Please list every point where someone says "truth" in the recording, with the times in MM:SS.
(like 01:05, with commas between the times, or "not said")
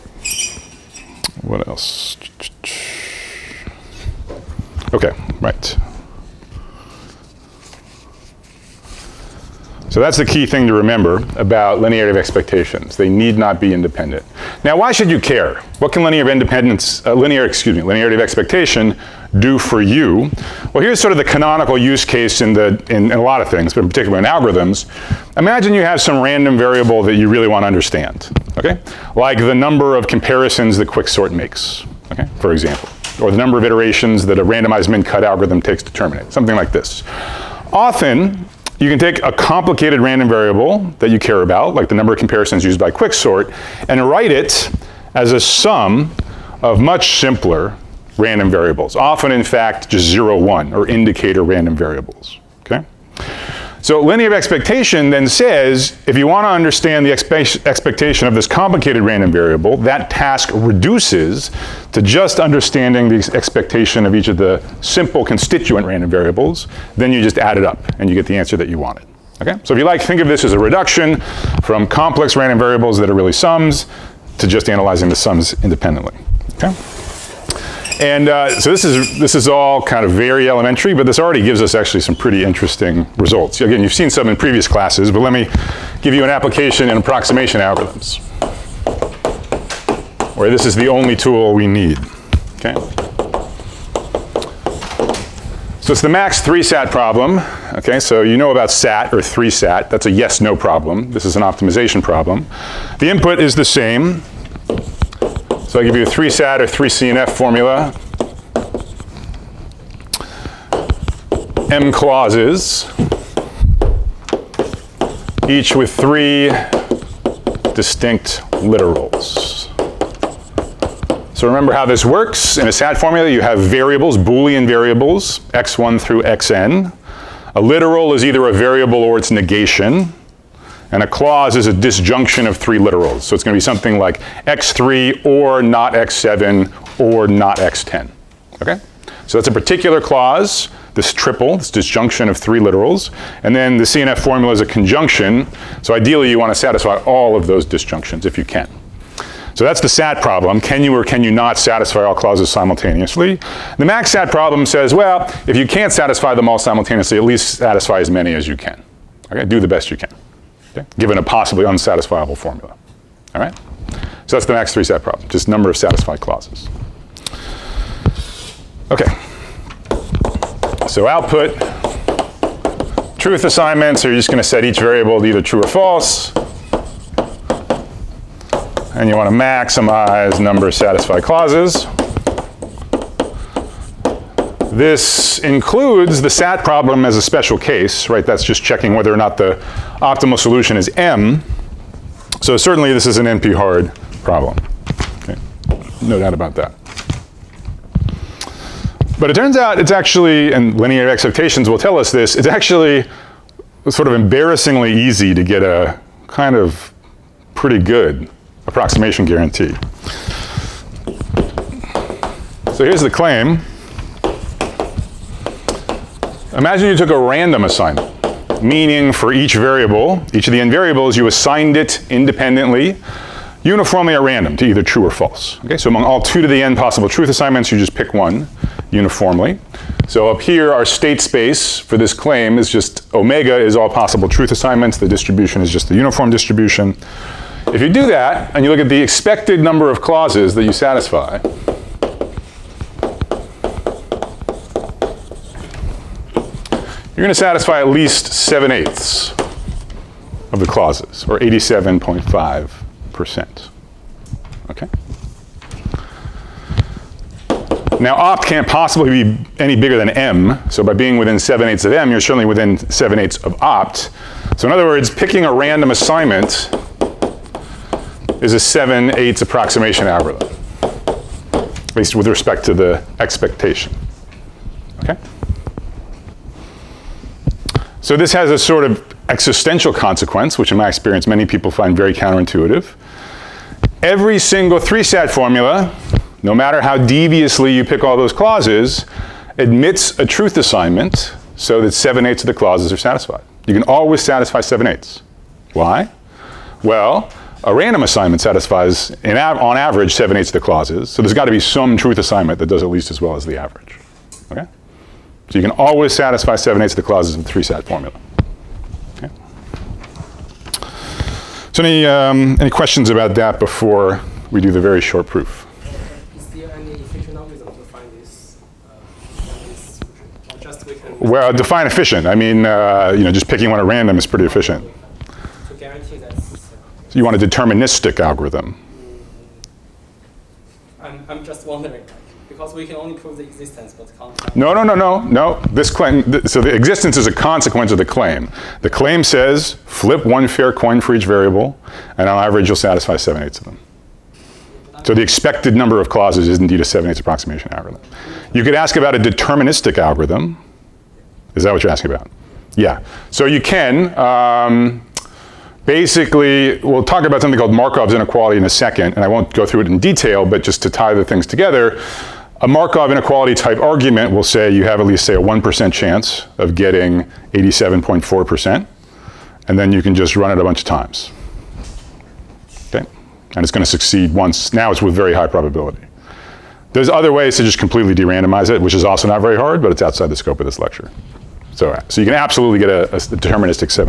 02:53, 03:47, 03:54, 04:50, 05:01.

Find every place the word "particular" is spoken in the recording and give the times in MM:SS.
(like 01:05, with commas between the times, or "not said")
00:23, 02:19.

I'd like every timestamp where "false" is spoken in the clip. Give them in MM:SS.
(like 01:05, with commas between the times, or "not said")
02:55, 03:45.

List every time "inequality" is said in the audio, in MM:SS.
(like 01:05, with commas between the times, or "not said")
05:58, 06:03.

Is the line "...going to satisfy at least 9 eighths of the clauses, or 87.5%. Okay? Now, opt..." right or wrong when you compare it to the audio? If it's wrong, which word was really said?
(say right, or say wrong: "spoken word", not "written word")
wrong: "7", not "9".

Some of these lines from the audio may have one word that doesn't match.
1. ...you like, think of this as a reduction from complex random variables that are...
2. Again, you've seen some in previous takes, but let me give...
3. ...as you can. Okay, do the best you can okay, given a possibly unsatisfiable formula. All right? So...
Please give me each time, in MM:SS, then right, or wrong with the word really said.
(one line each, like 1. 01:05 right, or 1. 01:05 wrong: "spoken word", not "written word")
1. 01:09 right
2. 01:23 wrong: "classes", not "takes"
3. 02:38 right.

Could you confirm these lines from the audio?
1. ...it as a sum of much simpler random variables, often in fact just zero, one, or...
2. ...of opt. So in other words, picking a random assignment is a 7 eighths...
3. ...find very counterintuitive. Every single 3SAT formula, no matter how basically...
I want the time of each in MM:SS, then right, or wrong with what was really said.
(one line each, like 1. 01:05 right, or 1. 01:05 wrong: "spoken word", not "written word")
1. 00:44 right
2. 04:23 right
3. 04:41 wrong: "deviously", not "basically".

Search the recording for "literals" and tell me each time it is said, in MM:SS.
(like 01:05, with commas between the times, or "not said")
01:58, 02:07, 02:12, 02:22.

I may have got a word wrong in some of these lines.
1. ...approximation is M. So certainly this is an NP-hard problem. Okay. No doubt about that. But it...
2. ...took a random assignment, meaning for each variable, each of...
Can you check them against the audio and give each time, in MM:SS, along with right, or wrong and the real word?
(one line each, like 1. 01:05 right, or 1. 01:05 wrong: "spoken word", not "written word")
1. 03:10 wrong: "solution", not "approximation"
2. 03:36 right.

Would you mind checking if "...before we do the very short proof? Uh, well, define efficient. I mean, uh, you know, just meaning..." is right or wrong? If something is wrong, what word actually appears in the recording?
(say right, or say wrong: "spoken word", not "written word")
wrong: "picking", not "meaning".